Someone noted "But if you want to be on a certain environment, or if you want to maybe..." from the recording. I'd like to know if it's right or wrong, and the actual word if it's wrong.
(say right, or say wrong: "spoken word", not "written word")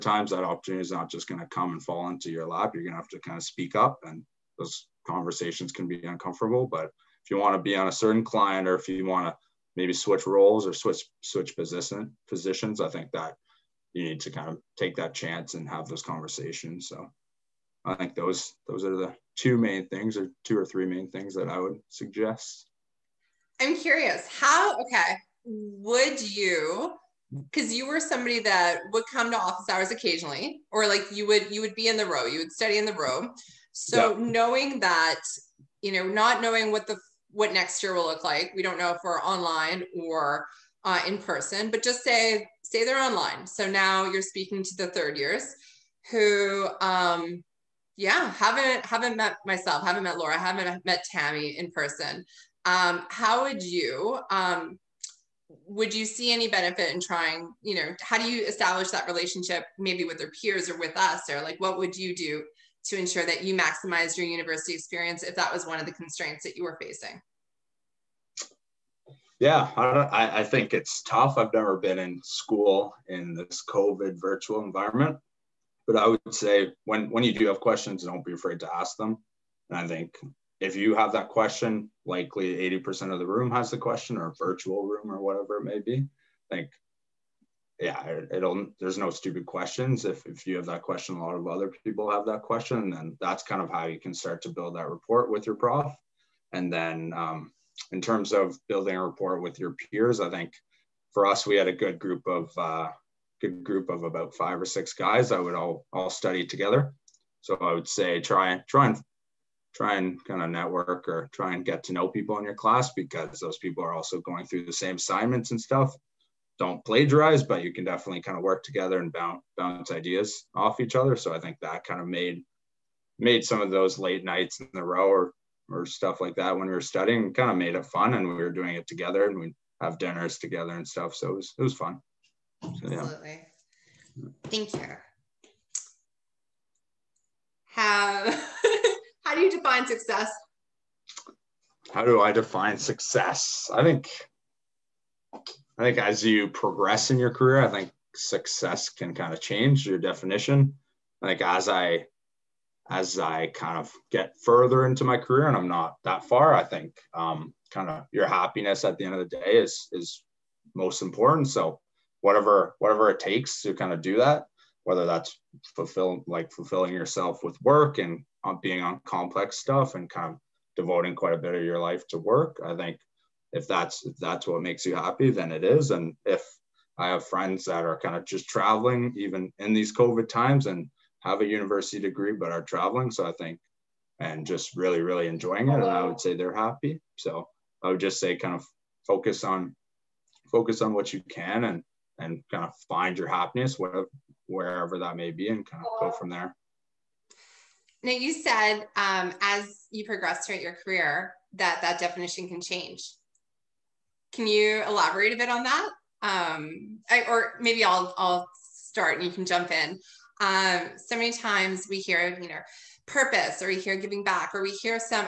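wrong: "client", not "environment".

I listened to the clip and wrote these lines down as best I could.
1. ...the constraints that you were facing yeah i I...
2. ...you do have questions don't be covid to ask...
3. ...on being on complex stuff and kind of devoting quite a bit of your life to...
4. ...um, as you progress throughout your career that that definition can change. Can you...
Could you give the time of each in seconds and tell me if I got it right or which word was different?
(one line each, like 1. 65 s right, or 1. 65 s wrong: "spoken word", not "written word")
1. 65 s right
2. 77 s wrong: "afraid", not "covid"
3. 168 s right
4. 198 s right.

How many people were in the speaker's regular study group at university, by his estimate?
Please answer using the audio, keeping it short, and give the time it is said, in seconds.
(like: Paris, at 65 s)
5 or 6, at 104 s.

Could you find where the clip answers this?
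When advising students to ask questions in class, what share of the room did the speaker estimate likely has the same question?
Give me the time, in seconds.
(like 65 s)
82 s.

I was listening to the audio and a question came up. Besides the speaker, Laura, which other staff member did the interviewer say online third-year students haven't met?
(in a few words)
Tammy.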